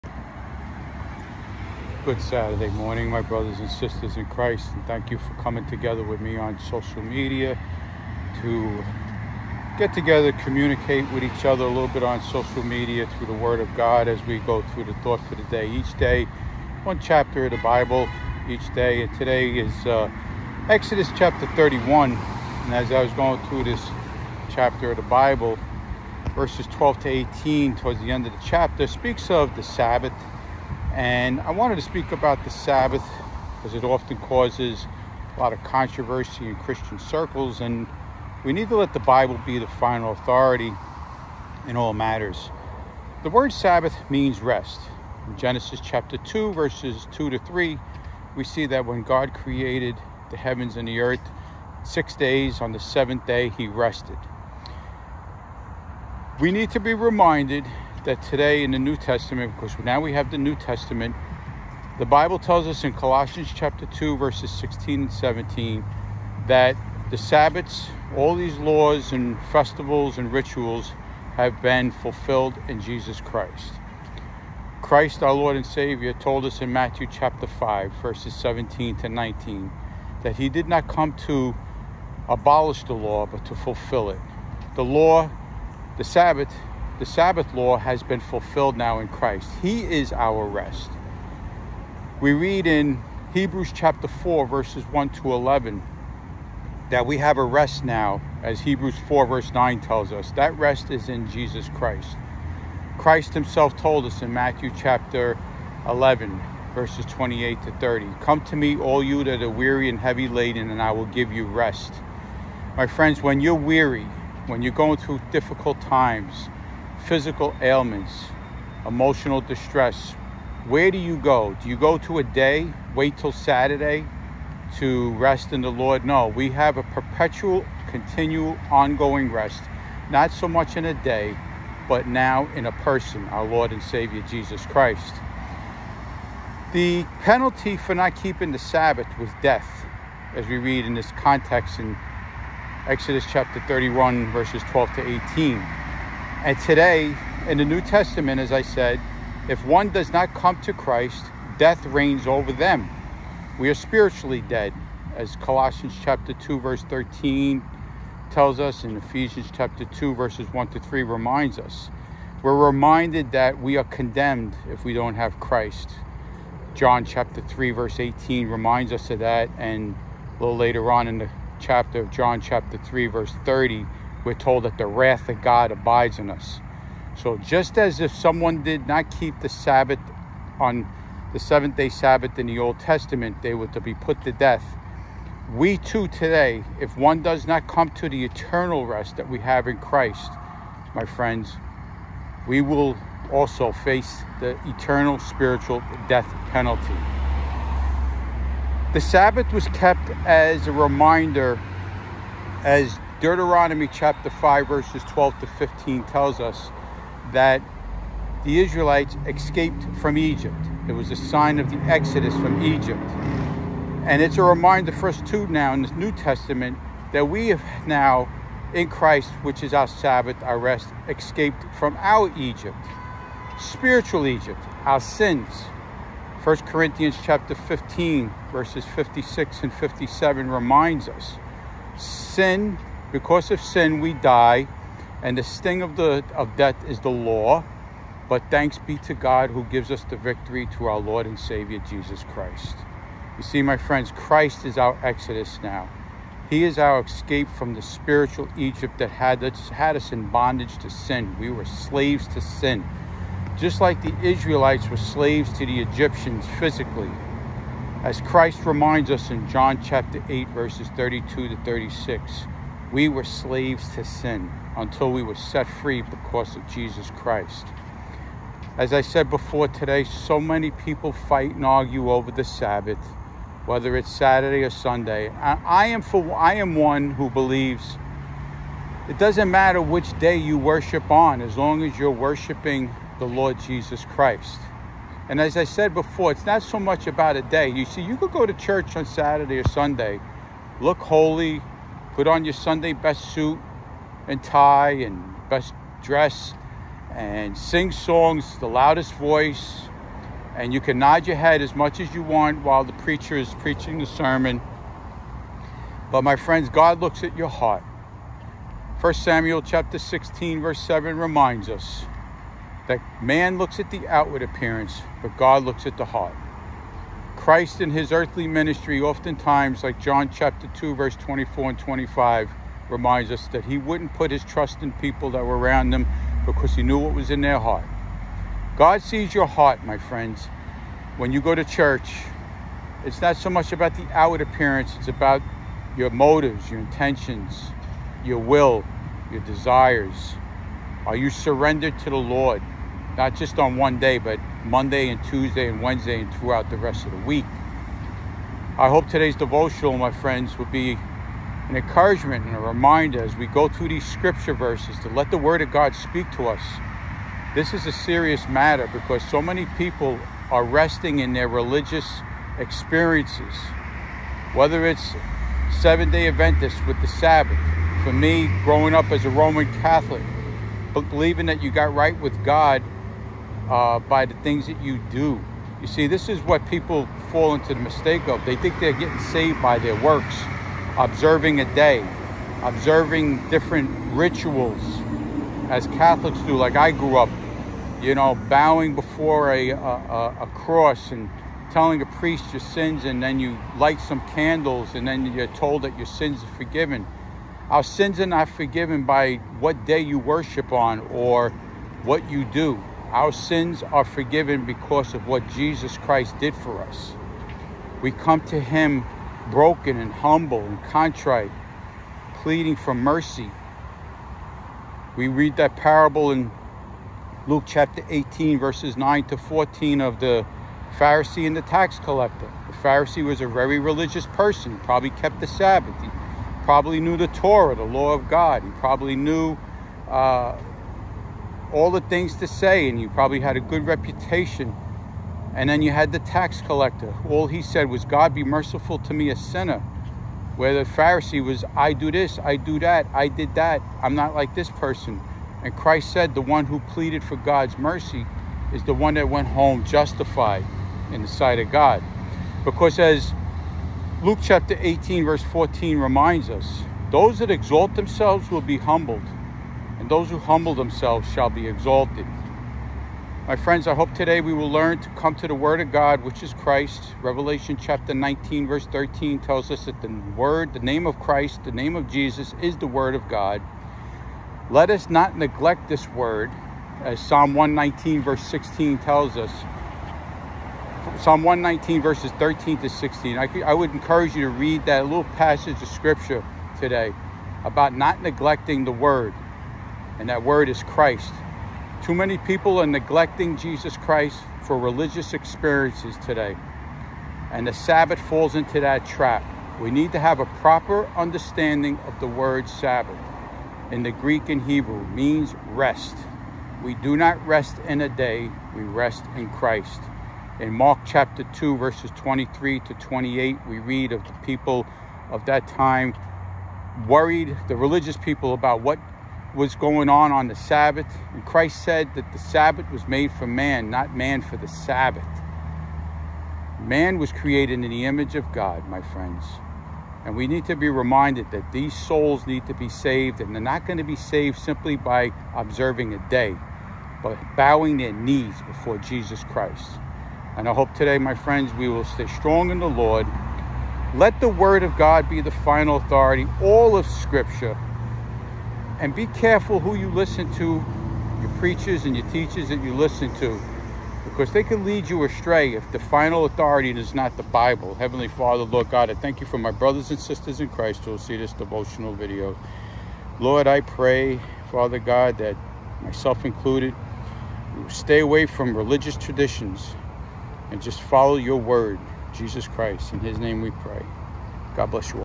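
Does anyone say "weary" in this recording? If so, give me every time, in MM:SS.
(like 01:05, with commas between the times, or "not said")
01:49, 01:53.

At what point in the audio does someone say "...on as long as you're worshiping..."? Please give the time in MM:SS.
04:41.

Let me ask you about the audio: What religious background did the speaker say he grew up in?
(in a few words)
Roman Catholic.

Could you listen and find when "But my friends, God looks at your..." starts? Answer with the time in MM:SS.
05:06.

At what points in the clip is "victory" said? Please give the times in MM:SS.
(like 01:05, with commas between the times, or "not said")
04:00.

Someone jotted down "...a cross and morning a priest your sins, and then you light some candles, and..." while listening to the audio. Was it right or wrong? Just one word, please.
wrong.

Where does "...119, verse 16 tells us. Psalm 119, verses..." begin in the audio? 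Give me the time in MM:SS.
07:57.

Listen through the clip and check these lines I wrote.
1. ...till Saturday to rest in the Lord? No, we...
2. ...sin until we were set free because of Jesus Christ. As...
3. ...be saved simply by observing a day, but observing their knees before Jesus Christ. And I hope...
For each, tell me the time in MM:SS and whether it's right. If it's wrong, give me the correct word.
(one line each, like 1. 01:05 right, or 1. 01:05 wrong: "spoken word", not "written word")
1. 02:03 right
2. 04:24 right
3. 08:54 wrong: "bowing", not "observing".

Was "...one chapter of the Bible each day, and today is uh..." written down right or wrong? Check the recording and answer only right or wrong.
right.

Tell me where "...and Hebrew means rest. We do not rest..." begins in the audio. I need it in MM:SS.
08:24.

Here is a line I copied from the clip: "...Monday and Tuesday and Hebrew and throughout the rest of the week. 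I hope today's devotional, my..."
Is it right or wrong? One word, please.
wrong.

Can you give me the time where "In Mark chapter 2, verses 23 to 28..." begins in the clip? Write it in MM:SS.
08:30.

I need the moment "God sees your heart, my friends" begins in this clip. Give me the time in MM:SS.
05:28.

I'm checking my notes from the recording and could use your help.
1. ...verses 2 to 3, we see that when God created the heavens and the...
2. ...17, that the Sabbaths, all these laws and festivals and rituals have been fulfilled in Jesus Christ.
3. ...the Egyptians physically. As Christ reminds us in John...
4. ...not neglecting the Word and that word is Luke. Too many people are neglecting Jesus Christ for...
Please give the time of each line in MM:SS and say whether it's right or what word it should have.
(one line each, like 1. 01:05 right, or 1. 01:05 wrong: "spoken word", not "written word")
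1. 00:46 right
2. 01:05 right
3. 04:15 right
4. 08:07 wrong: "Christ", not "Luke".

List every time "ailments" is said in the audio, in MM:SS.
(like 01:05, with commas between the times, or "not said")
01:57.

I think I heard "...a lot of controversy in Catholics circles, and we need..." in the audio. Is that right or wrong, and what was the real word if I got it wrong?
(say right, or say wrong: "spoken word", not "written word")
wrong: "Christian", not "Catholics".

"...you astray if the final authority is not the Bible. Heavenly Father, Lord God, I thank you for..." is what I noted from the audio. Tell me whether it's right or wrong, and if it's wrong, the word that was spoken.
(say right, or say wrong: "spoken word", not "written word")
right.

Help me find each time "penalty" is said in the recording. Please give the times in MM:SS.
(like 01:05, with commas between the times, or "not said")
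02:17, 03:16.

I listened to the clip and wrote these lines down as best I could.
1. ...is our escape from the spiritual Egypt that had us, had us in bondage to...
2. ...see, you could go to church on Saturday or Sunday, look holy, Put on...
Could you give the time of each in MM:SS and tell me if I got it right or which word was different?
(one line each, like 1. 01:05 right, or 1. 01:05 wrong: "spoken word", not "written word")
1. 04:06 right
2. 04:47 right.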